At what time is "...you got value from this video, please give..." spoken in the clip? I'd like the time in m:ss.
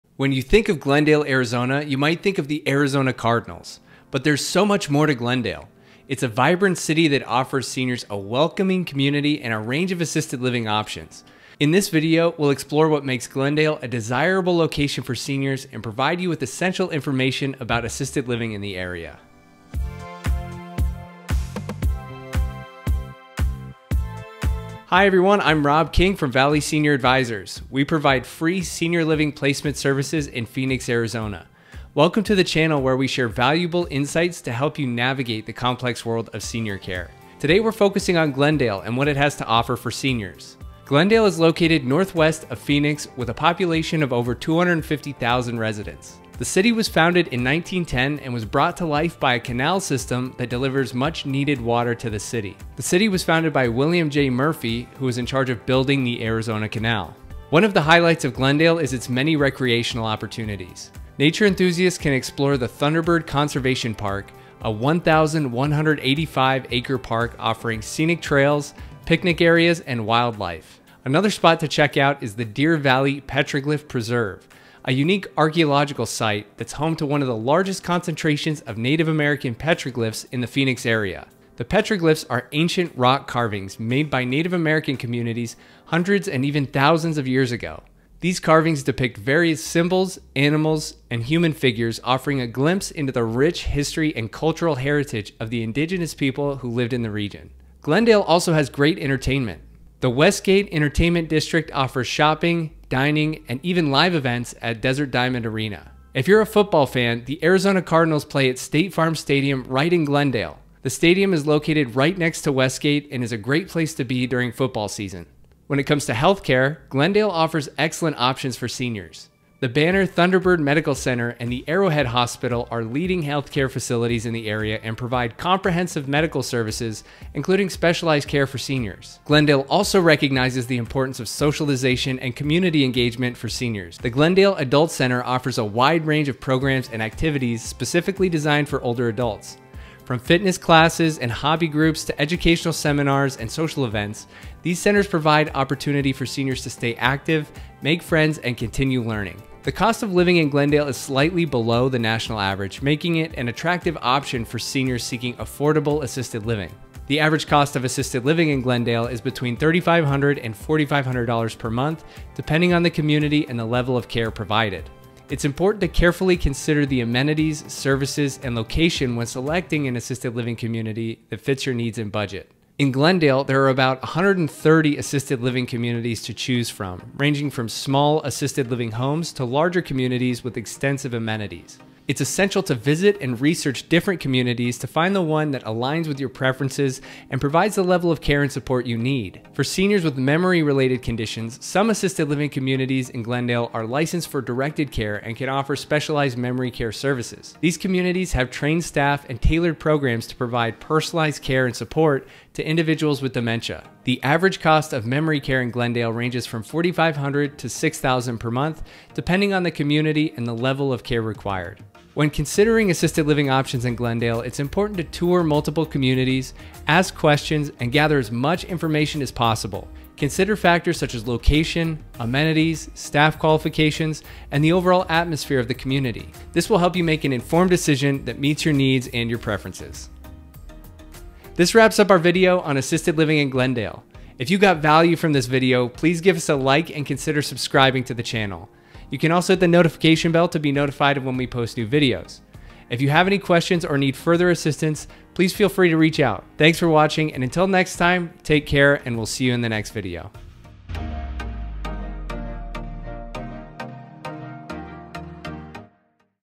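3:54.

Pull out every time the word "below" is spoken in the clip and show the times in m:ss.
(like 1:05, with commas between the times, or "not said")
2:31.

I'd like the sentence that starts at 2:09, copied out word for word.
Glendale also recognizes the importance of socialization and community engagement for seniors.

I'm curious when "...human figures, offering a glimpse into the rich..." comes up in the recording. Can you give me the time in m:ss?
1:31.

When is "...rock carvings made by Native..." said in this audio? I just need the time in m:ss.
1:22.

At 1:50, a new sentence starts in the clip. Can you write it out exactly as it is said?
The stadium is located right next to Westgate and is a great place to be during football season.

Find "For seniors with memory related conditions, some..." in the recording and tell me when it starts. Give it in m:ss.
3:09.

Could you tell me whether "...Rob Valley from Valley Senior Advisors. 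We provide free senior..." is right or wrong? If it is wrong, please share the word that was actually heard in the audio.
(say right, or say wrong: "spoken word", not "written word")
wrong: "King", not "Valley".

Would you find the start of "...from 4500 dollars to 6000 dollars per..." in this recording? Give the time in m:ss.
3:26.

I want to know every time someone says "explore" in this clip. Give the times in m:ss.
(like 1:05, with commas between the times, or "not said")
0:12, 1:02.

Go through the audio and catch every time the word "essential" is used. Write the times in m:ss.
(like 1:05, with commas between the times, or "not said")
0:16, 3:02.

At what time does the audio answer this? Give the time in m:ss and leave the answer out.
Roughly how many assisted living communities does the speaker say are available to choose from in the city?
2:54.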